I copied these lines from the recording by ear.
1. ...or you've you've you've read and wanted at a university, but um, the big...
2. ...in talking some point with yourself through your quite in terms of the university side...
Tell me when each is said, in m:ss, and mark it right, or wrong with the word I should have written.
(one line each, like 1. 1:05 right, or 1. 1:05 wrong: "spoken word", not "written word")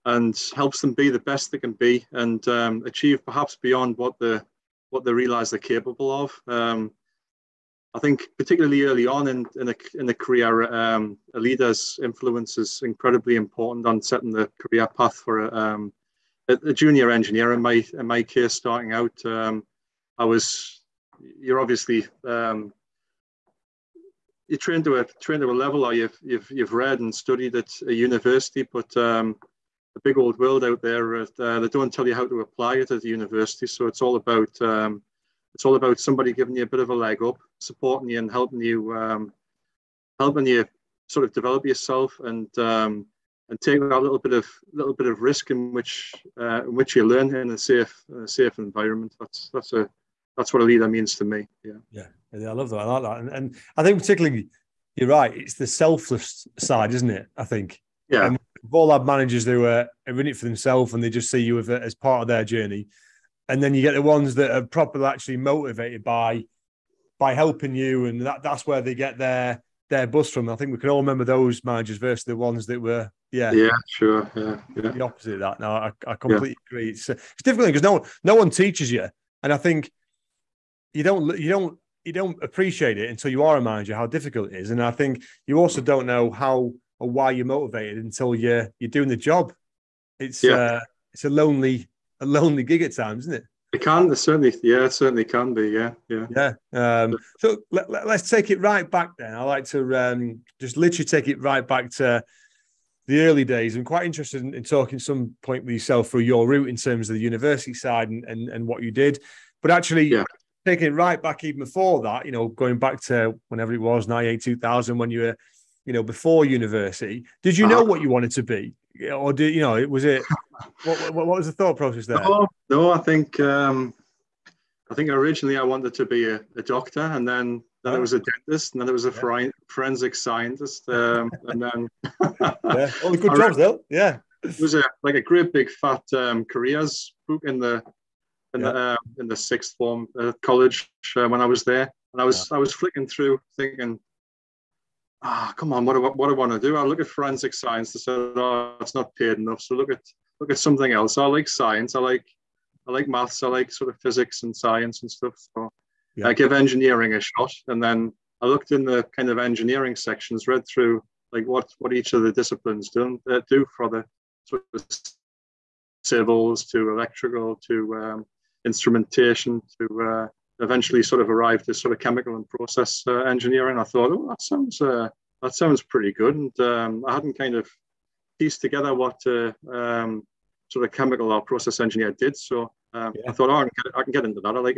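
1. 0:25 wrong: "studied", not "wanted"
2. 1:44 wrong: "route", not "quite".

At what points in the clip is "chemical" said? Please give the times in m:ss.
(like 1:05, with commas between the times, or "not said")
2:51, 3:00.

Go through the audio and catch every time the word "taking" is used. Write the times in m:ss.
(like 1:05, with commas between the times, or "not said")
1:50.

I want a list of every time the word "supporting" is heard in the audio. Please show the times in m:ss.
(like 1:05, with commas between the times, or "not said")
0:37.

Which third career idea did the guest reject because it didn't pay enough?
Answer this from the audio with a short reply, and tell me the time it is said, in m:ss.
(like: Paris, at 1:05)
Forensic scientist, at 2:09.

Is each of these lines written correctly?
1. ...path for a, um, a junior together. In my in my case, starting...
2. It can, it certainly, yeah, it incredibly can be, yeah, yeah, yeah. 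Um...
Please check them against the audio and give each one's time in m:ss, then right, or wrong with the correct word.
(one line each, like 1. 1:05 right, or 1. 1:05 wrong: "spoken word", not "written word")
1. 0:14 wrong: "engineer", not "together"
2. 1:33 wrong: "certainly", not "incredibly".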